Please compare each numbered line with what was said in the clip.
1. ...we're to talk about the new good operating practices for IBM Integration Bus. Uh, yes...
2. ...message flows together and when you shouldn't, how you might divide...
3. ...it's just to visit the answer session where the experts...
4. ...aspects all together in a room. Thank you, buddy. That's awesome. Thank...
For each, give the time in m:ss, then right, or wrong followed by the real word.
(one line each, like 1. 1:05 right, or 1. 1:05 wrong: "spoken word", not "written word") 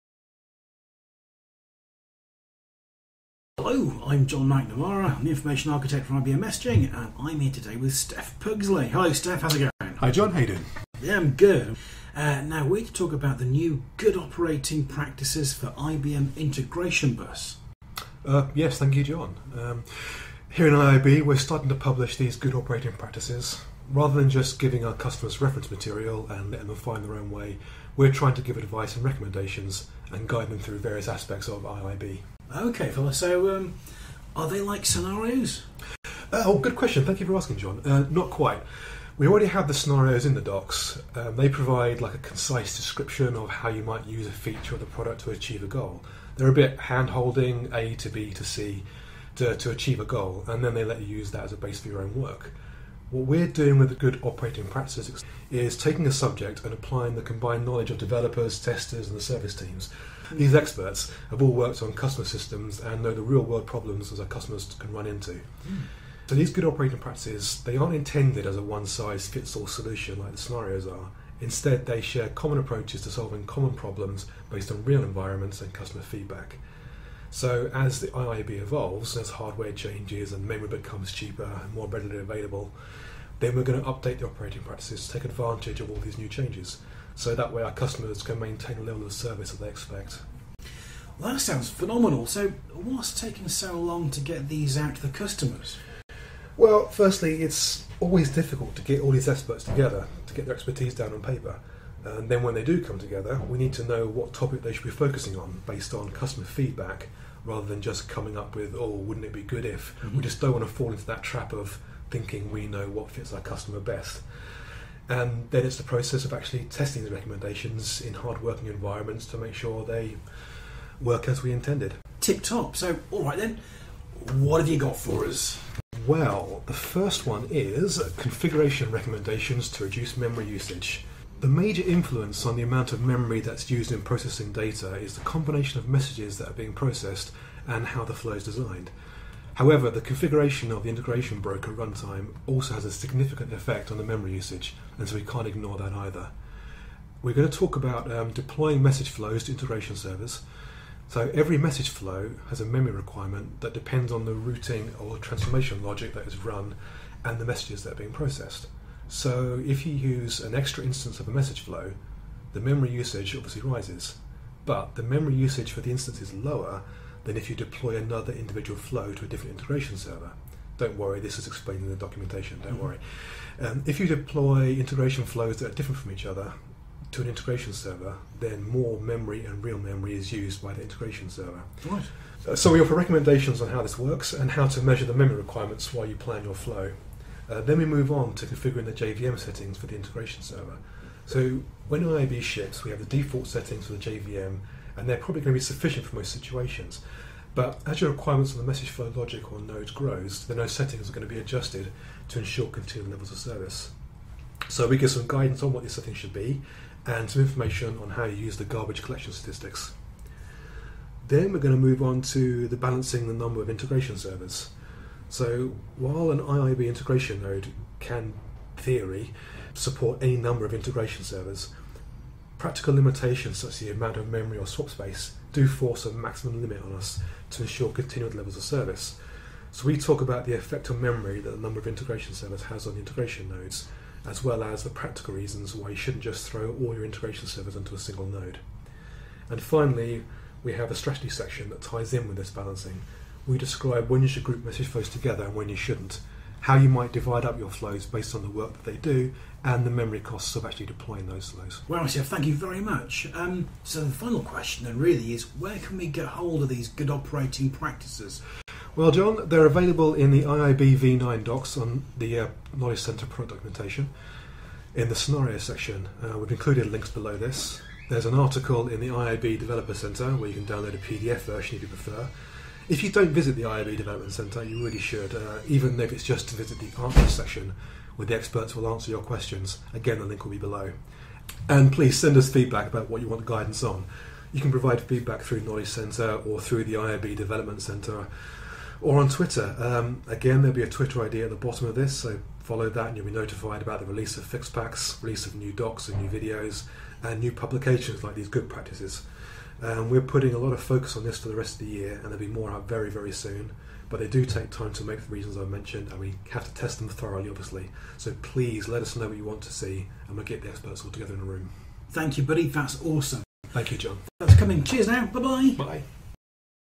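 1. 0:12 right
2. 4:04 right
3. 4:36 right
4. 5:10 wrong: "experts", not "aspects".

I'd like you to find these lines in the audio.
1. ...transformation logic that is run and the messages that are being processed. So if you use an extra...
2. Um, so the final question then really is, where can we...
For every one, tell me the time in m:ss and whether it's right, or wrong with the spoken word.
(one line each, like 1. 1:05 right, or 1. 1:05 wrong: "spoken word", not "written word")
1. 2:35 right
2. 4:13 right.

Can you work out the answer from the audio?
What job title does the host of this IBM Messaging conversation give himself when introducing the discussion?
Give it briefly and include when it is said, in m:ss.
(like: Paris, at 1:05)
Information Architect, at 0:05.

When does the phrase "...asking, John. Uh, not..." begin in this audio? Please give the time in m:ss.
0:37.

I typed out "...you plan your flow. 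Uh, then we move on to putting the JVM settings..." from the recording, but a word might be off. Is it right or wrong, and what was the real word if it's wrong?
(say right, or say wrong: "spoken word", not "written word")
wrong: "configuring", not "putting".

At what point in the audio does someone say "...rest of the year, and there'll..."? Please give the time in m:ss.
5:01.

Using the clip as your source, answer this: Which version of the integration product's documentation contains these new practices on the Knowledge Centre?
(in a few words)
IIB v9.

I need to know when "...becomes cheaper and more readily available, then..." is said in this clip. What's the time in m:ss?
1:20.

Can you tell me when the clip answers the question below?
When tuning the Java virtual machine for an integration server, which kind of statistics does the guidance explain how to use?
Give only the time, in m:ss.
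3:28.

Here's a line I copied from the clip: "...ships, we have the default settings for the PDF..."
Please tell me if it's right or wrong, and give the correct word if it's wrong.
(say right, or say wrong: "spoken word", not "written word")
wrong: "JVM", not "PDF".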